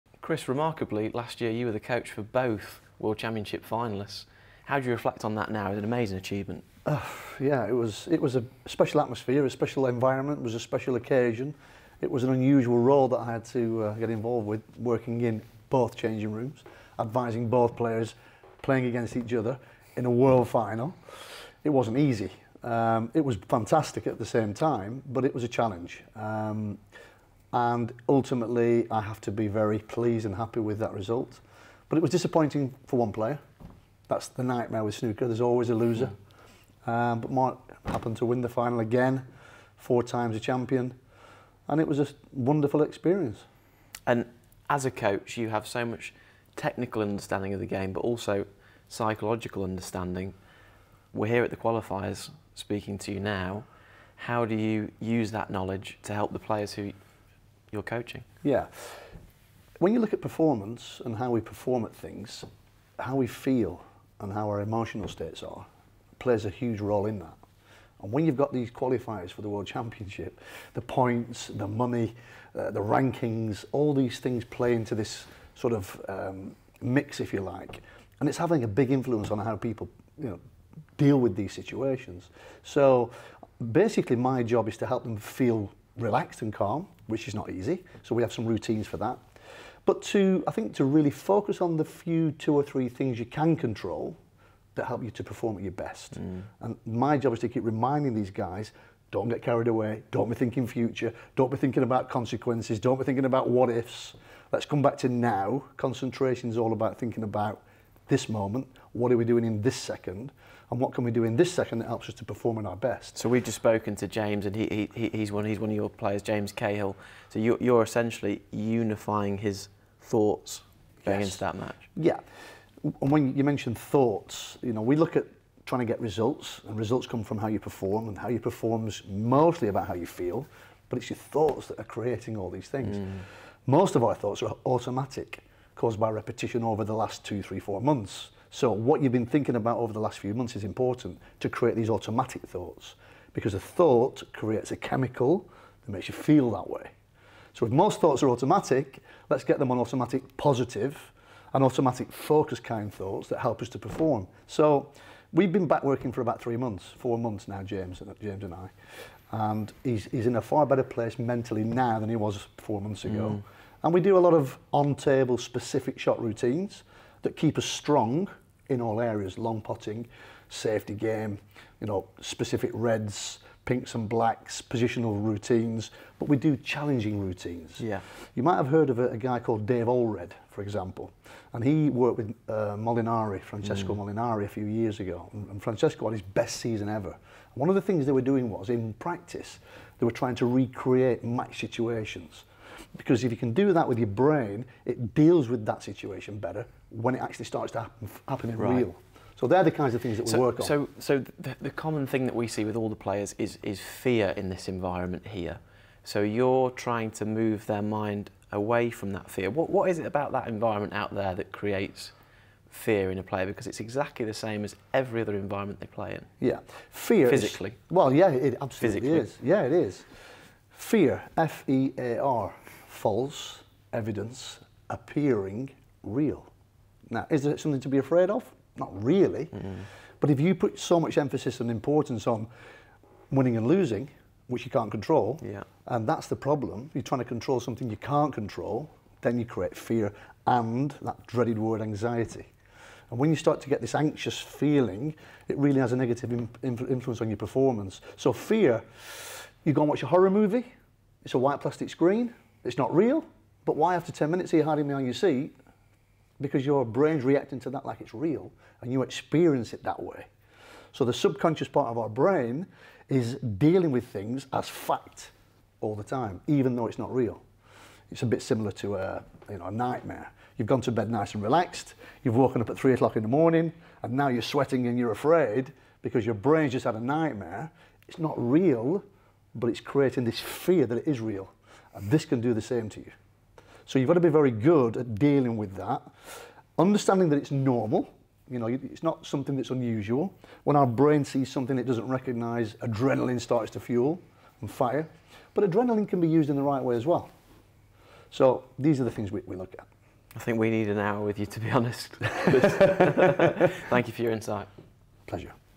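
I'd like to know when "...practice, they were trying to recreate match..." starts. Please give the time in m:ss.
3:08.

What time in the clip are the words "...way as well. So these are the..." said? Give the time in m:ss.
4:56.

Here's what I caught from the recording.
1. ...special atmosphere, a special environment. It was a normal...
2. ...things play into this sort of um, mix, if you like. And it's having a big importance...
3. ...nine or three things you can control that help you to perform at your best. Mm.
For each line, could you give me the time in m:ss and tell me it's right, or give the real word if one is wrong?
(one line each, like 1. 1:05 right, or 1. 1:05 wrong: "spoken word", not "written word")
1. 0:08 wrong: "special", not "normal"
2. 1:14 wrong: "influence", not "importance"
3. 1:32 wrong: "two", not "nine".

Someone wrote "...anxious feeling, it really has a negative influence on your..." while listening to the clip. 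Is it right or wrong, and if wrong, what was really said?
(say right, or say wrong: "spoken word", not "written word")
right.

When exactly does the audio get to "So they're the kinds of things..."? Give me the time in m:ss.
3:19.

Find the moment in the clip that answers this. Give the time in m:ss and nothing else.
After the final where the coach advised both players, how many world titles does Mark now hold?
0:39.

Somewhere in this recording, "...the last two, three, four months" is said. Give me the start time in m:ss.
2:16.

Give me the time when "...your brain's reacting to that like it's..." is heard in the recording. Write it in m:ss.
4:16.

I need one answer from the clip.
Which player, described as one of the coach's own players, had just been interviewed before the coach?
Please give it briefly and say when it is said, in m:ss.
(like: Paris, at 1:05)
James Cahill, at 1:56.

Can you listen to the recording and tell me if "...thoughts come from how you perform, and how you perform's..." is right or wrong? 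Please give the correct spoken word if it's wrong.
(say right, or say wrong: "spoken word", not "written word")
wrong: "results", not "thoughts".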